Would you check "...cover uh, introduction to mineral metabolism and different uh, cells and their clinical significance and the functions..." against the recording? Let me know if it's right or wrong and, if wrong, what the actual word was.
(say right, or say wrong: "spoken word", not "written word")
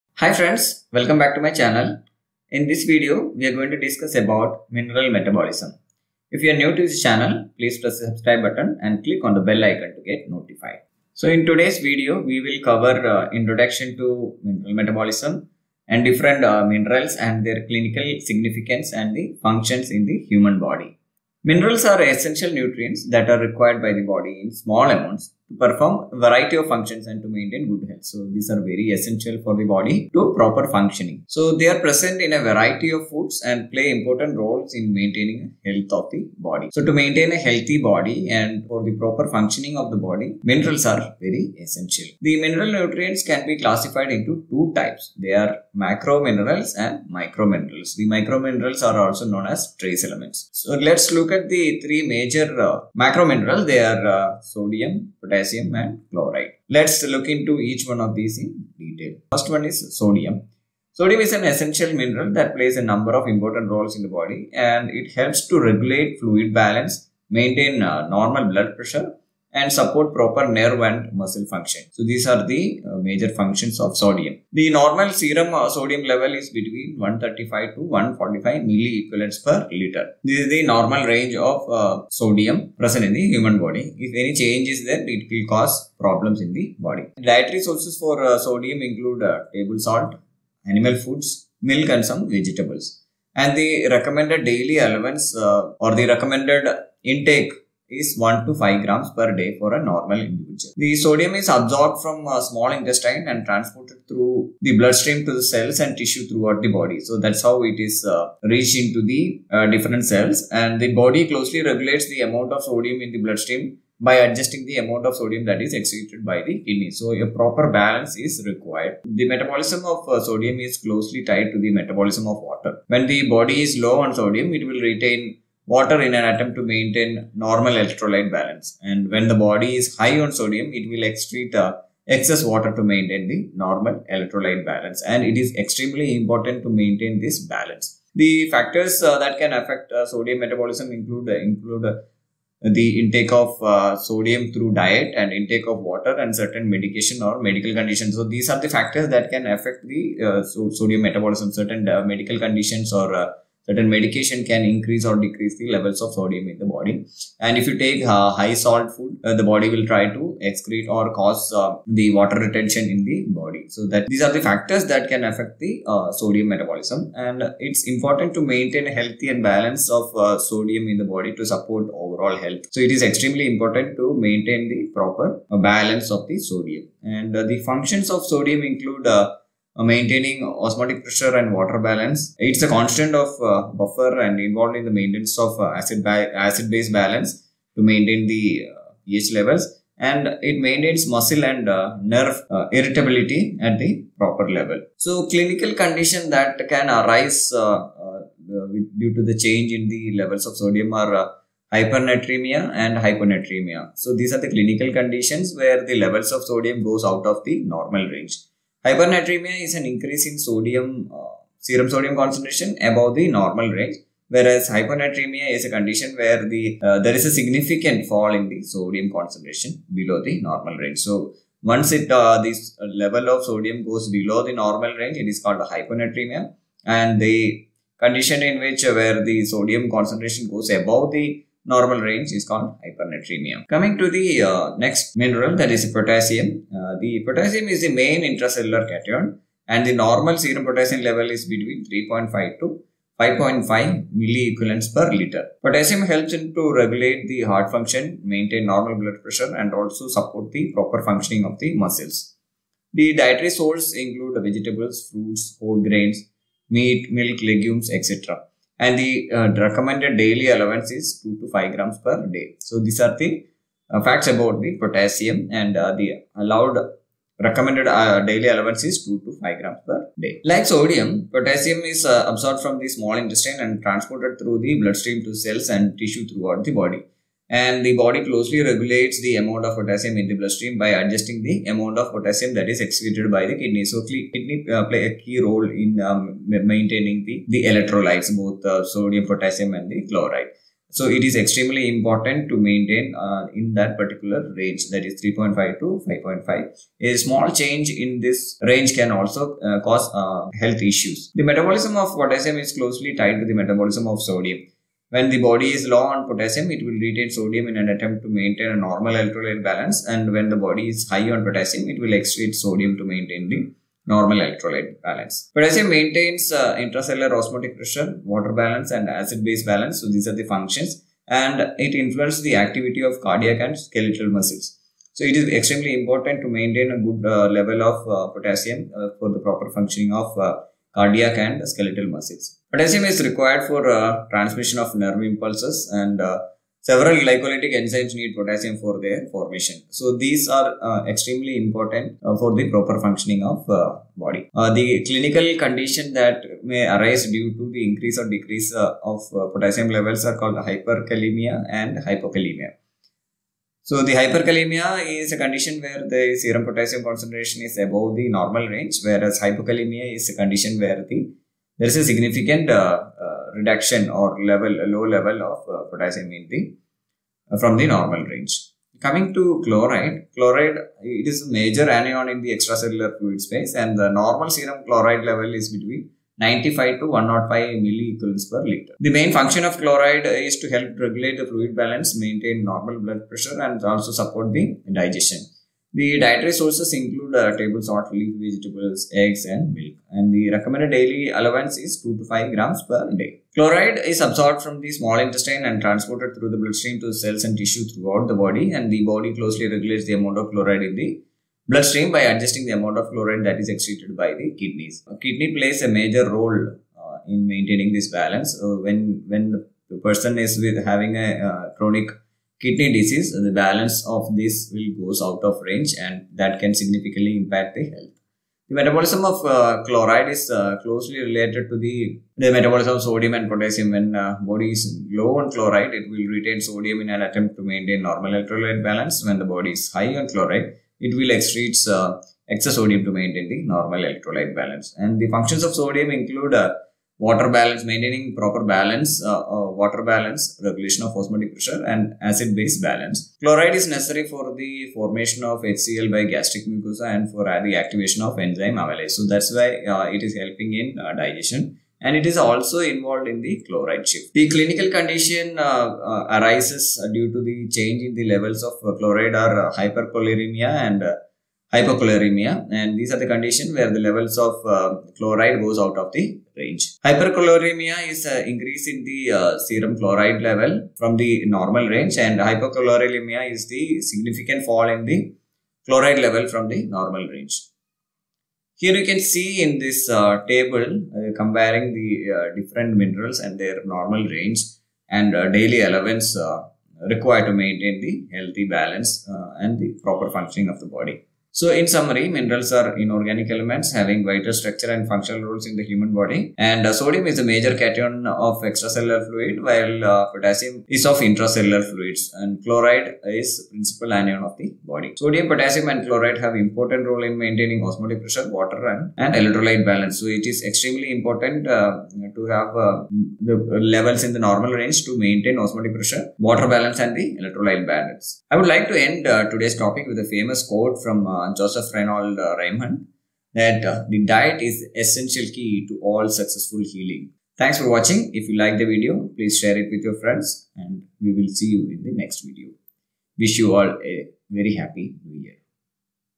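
wrong: "minerals", not "cells".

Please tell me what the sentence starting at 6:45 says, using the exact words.
A kidney plays a major role uh, in maintaining this balance.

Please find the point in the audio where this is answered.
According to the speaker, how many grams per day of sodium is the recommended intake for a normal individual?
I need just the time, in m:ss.
1:38.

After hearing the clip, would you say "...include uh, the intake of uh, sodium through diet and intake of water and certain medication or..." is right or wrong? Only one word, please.
right.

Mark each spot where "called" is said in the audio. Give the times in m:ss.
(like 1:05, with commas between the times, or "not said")
3:45, 3:52, 5:50.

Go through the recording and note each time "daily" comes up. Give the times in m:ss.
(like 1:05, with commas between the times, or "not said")
1:34, 4:20, 4:28, 6:30, 8:05.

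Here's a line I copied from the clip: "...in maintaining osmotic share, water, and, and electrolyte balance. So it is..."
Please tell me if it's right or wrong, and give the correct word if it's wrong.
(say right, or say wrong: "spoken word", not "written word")
wrong: "pressure", not "share".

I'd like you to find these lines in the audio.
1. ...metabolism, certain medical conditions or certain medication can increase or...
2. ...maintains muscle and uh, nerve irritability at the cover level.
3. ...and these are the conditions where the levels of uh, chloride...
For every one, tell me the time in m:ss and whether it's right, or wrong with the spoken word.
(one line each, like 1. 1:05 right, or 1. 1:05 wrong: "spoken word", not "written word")
1. 2:31 right
2. 3:10 wrong: "proper", not "cover"
3. 7:42 right.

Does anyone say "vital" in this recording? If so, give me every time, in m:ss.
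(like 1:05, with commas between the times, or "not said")
8:14.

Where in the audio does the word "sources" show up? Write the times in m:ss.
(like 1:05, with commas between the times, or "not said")
1:27, 4:13, 6:26.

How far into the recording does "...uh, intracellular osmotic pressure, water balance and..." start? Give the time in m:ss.
5:16.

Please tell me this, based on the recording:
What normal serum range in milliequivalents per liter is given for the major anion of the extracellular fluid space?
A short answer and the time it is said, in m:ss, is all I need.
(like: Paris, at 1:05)
95 to 105, at 6:16.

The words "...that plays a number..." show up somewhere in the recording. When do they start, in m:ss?
1:02.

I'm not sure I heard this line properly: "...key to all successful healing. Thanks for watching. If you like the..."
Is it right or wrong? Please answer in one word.
right.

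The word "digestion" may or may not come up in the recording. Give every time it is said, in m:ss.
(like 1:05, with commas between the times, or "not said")
6:25, 7:31.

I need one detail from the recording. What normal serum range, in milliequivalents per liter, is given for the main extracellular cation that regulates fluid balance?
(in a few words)
135 to 145.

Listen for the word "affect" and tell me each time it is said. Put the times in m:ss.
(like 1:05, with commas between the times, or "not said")
2:19, 2:29, 2:45.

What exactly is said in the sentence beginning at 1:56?
So a proper balance is required.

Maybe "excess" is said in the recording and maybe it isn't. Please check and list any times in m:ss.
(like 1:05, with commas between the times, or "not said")
2:12, 7:12.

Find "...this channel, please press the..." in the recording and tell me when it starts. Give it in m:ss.
0:06.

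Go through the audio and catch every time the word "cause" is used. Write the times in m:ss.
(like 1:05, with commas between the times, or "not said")
1:25, 2:41, 4:59.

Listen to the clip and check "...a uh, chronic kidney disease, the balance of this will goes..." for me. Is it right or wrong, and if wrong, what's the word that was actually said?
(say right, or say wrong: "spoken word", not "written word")
right.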